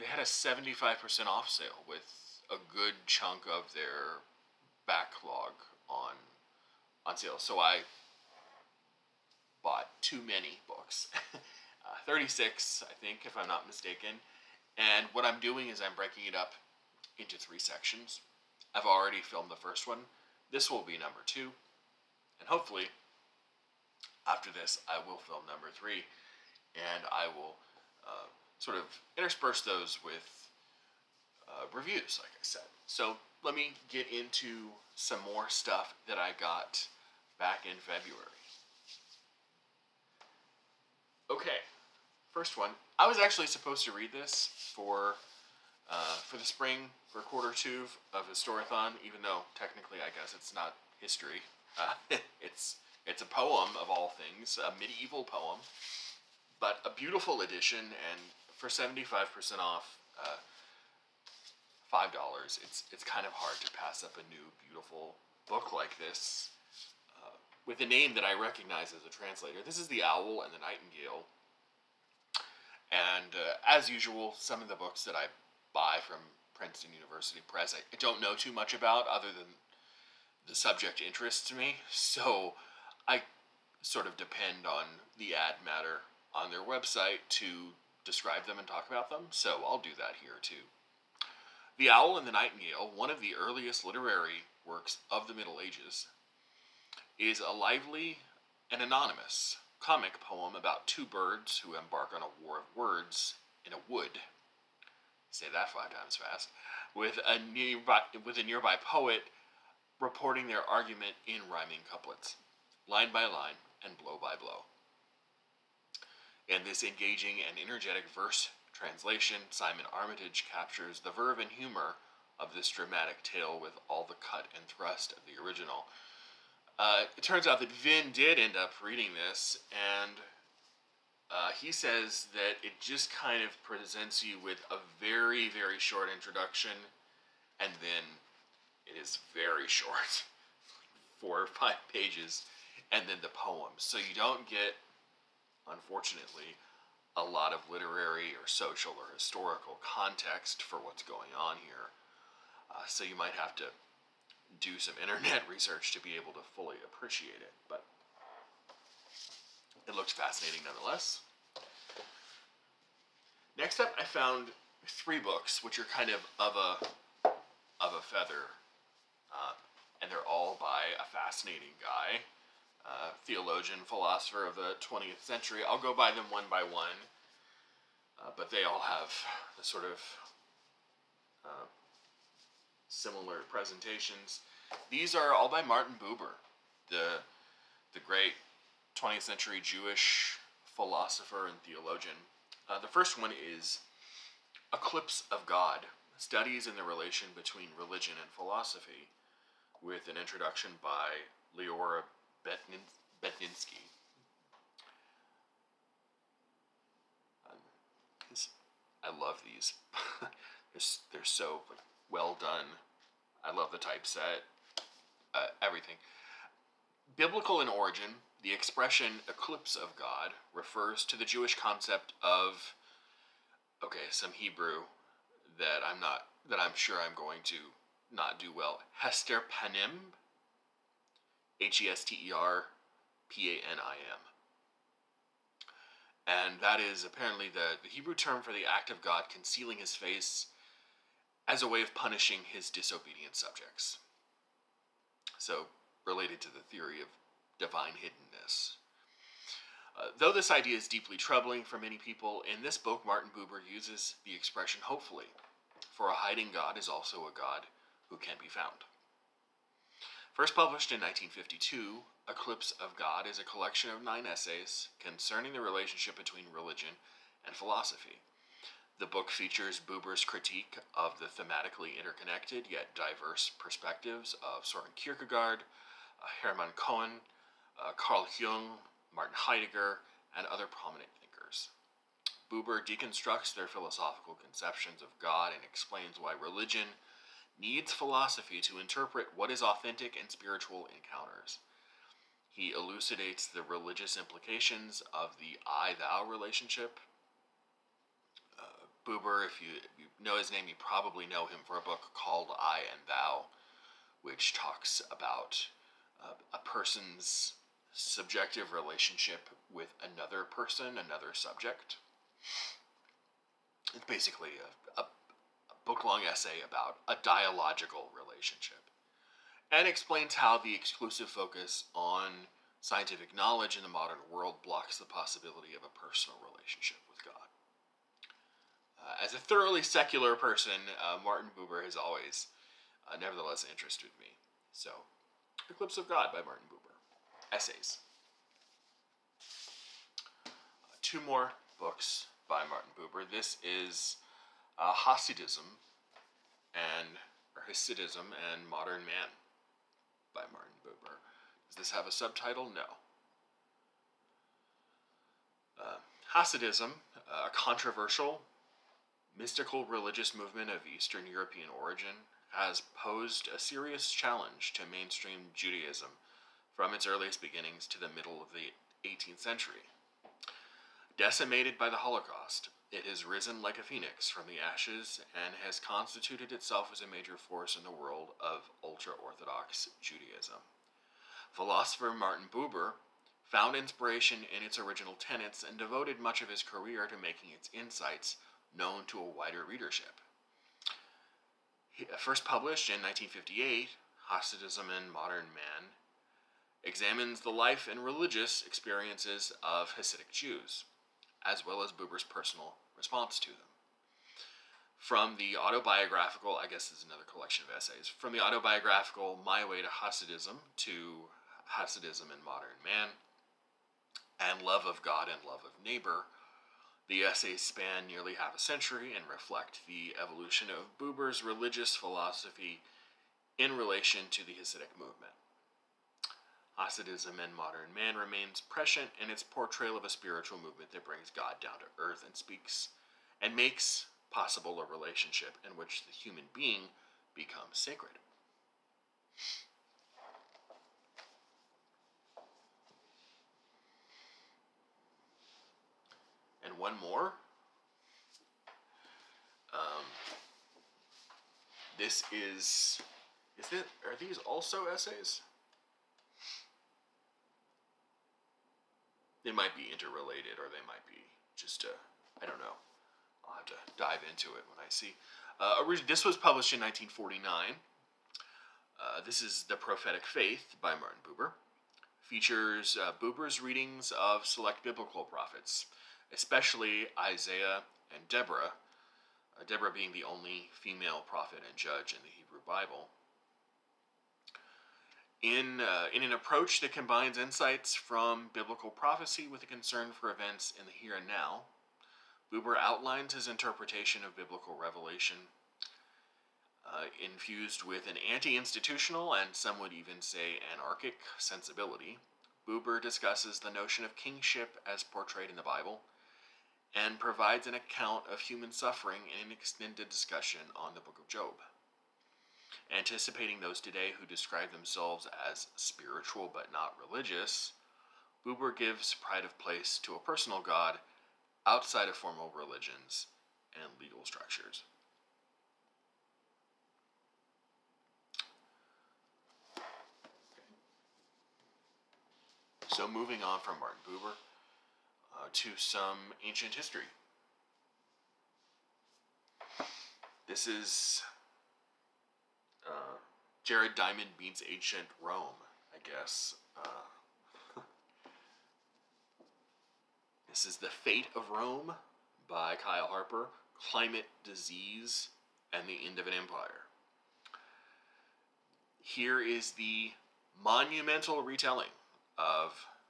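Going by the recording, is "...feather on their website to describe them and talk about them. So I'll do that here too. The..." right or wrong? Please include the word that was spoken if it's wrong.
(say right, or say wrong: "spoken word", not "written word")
wrong: "matter", not "feather".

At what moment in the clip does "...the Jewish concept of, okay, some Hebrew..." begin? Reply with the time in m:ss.
3:41.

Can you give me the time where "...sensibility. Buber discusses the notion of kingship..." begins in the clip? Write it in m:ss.
8:21.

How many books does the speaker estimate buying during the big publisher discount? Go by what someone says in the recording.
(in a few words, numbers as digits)
36.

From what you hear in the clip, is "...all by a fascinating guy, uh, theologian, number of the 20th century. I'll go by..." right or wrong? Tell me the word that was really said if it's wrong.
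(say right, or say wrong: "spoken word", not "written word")
wrong: "philosopher", not "number".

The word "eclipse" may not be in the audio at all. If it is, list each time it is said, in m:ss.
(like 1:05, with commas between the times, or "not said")
3:14, 3:39, 4:22, 5:35.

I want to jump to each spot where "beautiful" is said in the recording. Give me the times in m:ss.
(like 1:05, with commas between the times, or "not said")
0:57, 1:04.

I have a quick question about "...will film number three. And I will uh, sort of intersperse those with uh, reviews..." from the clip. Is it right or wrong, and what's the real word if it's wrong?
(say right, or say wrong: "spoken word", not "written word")
right.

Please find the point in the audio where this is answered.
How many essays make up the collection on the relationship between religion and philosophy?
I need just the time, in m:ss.
4:24.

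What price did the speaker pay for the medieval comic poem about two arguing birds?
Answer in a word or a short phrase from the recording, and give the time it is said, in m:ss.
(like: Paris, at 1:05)
$5, at 1:01.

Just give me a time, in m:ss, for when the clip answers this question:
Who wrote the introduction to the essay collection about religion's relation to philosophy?
3:21.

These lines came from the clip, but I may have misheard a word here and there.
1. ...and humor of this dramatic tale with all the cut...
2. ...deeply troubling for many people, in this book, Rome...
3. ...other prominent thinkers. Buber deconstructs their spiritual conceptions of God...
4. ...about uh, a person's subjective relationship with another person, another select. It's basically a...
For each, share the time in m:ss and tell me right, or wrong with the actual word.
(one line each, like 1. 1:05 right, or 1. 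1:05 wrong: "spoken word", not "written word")
1. 2:01 right
2. 4:10 wrong: "Martin", not "Rome"
3. 4:40 wrong: "philosophical", not "spiritual"
4. 5:05 wrong: "subject", not "select".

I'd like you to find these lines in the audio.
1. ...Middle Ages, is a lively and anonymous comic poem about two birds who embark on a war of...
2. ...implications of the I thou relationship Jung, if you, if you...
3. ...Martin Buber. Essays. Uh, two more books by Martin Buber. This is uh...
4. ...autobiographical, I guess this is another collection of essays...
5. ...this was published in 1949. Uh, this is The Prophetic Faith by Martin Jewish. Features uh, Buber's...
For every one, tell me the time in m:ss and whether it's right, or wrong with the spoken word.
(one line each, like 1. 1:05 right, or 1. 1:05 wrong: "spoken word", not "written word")
1. 1:35 right
2. 4:54 wrong: "Buber", not "Jung"
3. 5:36 right
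4. 6:45 right
5. 7:46 wrong: "Buber", not "Jewish".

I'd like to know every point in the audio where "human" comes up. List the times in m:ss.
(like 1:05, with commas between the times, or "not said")
7:16, 8:28.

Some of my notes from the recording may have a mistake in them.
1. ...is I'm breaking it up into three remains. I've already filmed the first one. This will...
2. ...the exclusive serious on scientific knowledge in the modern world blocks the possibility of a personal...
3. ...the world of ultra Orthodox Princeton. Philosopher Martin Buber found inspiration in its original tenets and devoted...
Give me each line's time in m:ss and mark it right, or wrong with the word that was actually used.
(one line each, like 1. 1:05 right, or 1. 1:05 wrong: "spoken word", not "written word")
1. 0:15 wrong: "sections", not "remains"
2. 5:20 wrong: "focus", not "serious"
3. 6:17 wrong: "Judaism", not "Princeton".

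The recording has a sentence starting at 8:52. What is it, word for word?
So, moving on from Martin Buber, to some ancient history.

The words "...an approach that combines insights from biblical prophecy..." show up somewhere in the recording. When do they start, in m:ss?
8:06.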